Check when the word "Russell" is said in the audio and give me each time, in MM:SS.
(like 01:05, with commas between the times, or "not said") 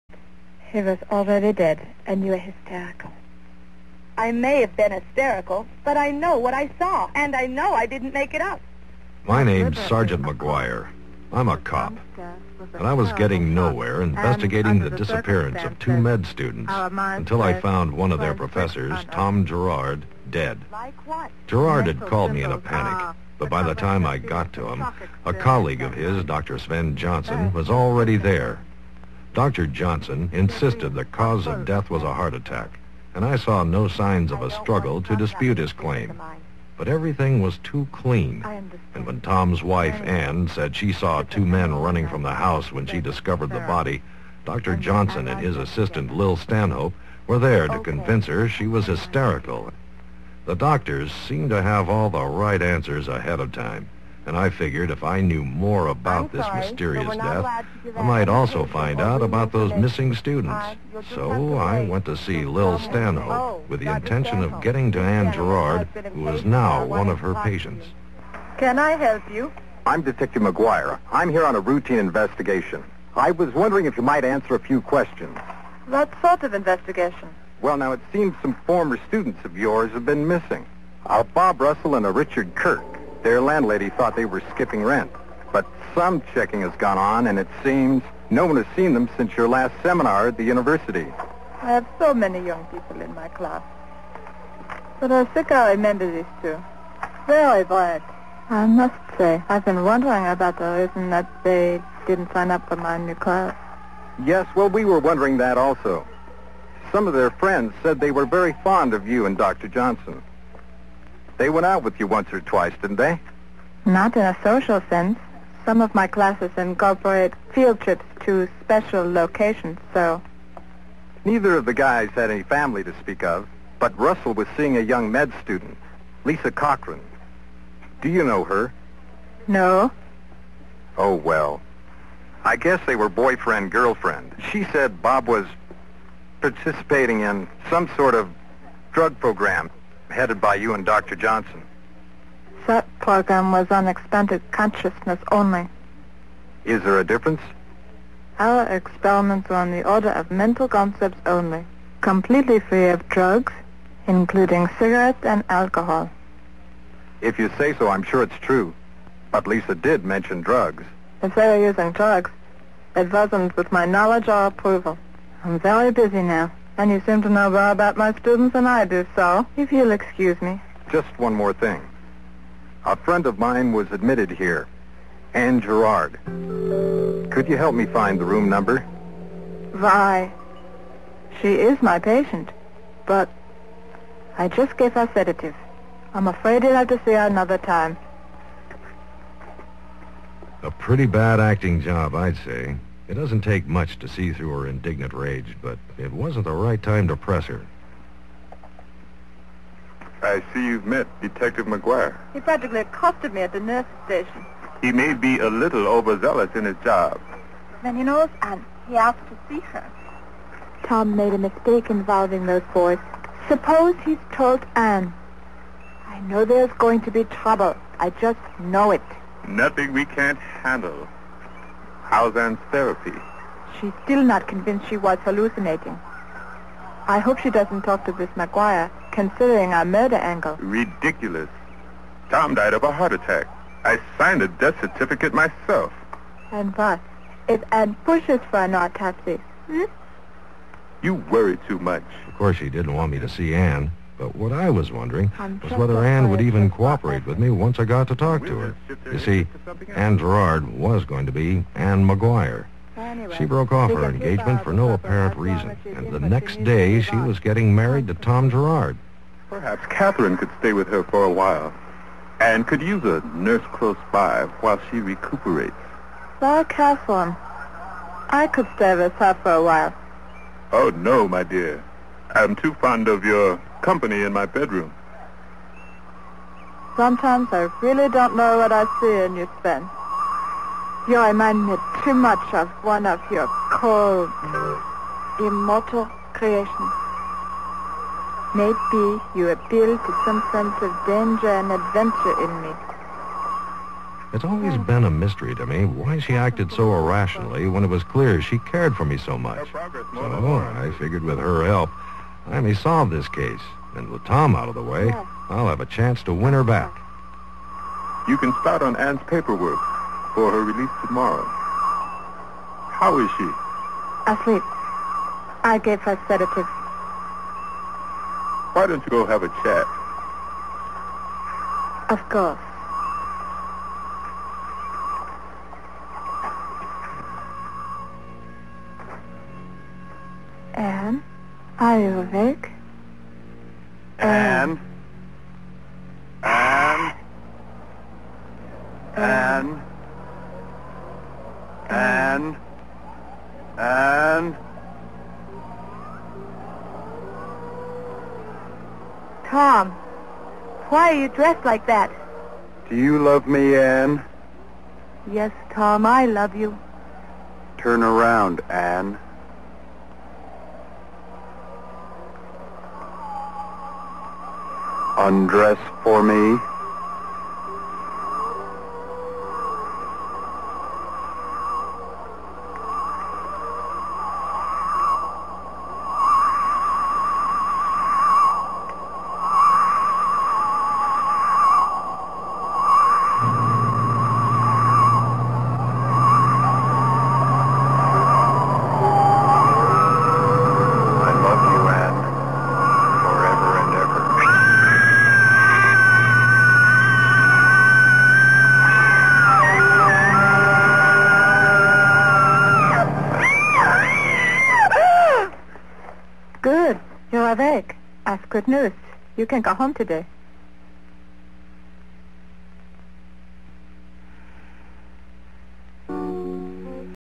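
01:21, 02:03.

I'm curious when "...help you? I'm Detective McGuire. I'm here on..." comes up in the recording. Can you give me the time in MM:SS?
01:08.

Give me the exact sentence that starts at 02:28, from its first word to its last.
Our experiments were on the order of mental concepts only, completely free of drugs, including cigarettes and alcohol.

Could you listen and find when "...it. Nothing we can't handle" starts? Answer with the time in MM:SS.
03:38.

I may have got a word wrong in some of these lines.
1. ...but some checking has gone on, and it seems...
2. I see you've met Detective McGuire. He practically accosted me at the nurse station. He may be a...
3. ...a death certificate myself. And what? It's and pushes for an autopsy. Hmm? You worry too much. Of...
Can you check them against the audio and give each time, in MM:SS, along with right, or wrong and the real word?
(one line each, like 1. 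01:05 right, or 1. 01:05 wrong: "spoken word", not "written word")
1. 01:25 right
2. 03:20 right
3. 03:54 right.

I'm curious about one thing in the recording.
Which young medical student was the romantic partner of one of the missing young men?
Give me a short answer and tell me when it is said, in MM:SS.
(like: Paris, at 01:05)
Lisa Cochran, at 02:06.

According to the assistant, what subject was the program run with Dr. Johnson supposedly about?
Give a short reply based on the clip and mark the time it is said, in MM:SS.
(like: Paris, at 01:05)
expanded consciousness, at 02:23.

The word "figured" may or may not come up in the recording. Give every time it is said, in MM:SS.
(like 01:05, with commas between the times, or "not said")
00:54, 05:00.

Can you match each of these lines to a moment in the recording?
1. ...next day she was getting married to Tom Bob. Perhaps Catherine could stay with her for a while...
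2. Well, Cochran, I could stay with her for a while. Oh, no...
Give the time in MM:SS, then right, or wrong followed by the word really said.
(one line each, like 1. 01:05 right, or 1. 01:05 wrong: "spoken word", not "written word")
1. 04:16 wrong: "Gerard", not "Bob"
2. 04:26 wrong: "Catherine", not "Cochran".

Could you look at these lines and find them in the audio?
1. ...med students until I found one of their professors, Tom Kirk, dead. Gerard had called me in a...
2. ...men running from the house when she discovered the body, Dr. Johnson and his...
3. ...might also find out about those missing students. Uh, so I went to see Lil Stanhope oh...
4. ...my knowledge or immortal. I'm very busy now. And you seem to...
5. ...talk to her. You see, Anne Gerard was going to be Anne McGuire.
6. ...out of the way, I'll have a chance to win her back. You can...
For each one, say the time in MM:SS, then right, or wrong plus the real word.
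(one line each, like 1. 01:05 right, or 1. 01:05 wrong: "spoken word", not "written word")
1. 00:15 wrong: "Gerard", not "Kirk"
2. 00:41 right
3. 00:58 right
4. 02:43 wrong: "approval", not "immortal"
5. 04:08 right
6. 05:04 right.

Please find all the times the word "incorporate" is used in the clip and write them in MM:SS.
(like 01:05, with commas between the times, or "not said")
01:56.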